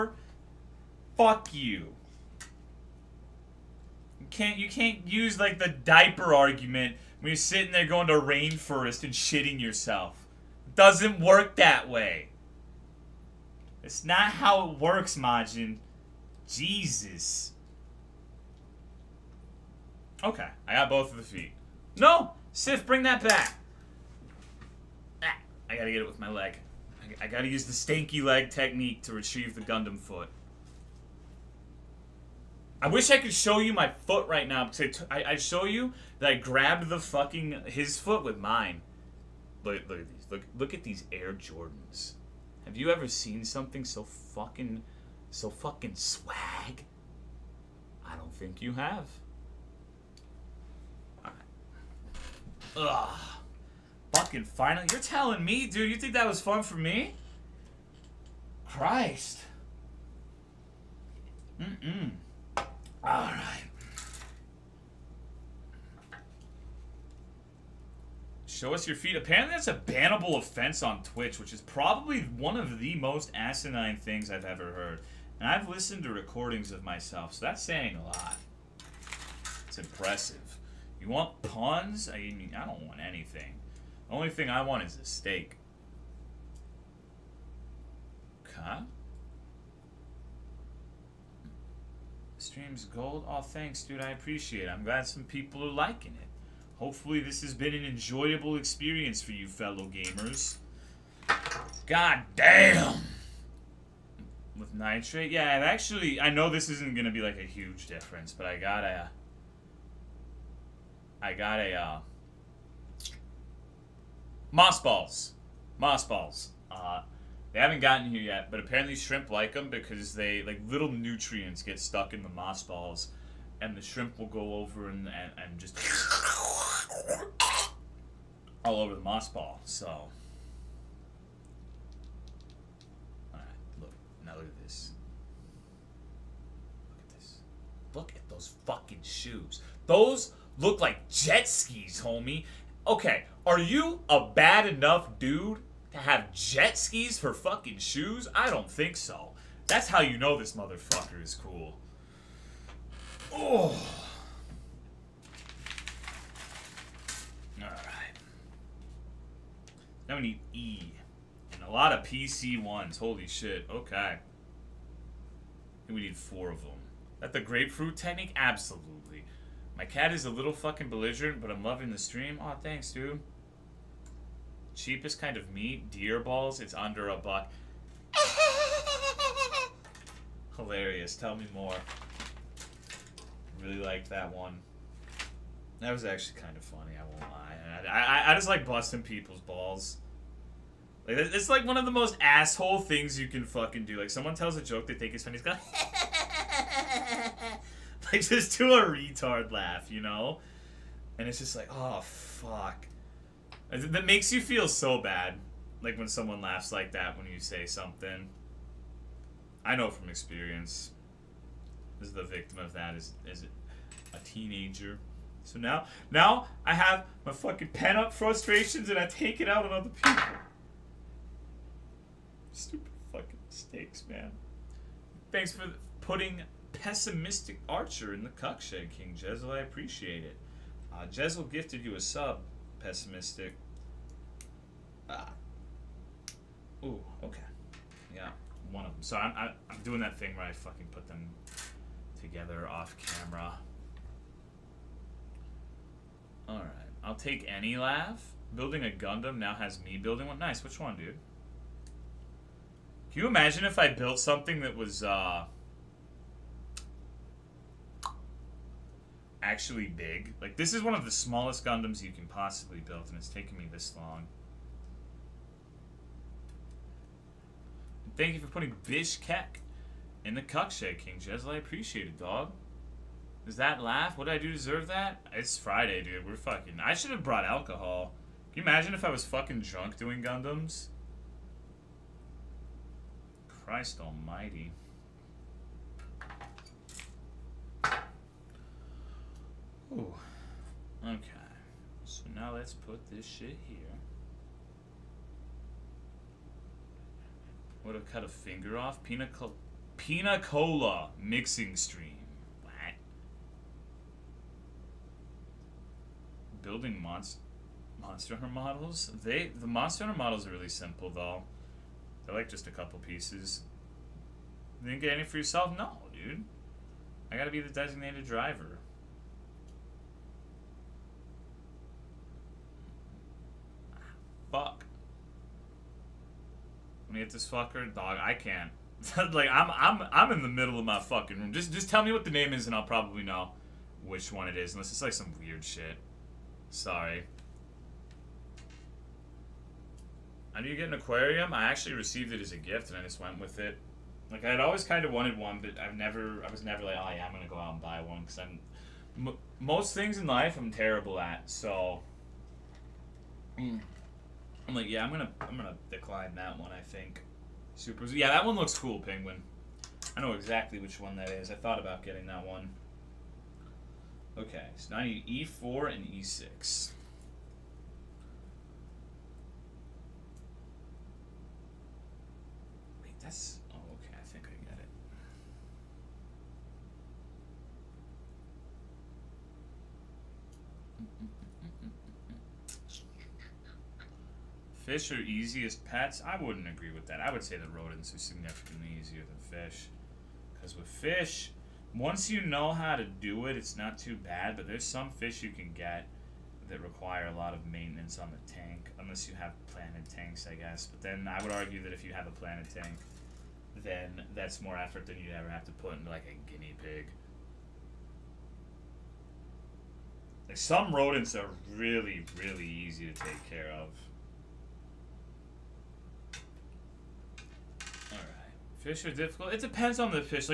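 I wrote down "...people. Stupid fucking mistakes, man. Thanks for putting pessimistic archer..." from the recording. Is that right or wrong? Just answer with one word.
right.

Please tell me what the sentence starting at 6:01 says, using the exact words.
I thought about getting that one.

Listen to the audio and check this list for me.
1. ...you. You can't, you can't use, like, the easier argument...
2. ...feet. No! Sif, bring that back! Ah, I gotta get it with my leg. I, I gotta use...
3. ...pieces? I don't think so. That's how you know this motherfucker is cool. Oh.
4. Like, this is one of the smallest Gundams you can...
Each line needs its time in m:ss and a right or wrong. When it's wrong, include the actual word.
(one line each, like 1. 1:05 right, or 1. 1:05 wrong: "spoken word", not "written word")
1. 0:01 wrong: "diaper", not "easier"
2. 0:21 right
3. 2:27 wrong: "shoes", not "pieces"
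4. 4:20 right.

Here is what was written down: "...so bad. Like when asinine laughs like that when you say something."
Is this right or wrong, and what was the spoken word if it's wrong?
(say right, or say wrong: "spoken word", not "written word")
wrong: "someone", not "asinine".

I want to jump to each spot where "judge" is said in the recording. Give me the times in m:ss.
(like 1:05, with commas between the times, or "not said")
not said.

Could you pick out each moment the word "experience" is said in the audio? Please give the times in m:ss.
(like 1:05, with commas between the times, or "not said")
1:38, 3:30.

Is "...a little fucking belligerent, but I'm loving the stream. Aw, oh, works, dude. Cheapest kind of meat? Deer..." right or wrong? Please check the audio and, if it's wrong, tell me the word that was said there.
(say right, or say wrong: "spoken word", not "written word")
wrong: "thanks", not "works".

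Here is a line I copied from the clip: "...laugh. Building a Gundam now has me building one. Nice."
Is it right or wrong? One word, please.
right.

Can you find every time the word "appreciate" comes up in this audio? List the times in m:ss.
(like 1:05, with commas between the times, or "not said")
1:34, 3:49, 4:31.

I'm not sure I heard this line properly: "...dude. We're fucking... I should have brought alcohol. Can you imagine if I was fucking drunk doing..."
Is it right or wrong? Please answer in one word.
right.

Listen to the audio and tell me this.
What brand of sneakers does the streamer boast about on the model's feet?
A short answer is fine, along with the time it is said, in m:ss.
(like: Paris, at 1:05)
Air Jordans, at 0:41.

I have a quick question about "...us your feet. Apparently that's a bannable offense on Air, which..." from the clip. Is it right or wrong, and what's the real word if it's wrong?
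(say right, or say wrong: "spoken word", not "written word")
wrong: "Twitch", not "Air".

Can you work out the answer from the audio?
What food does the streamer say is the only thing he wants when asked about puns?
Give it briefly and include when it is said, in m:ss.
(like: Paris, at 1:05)
steak, at 1:25.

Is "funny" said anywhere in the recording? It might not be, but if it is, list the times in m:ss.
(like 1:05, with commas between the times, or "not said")
3:06, 3:15.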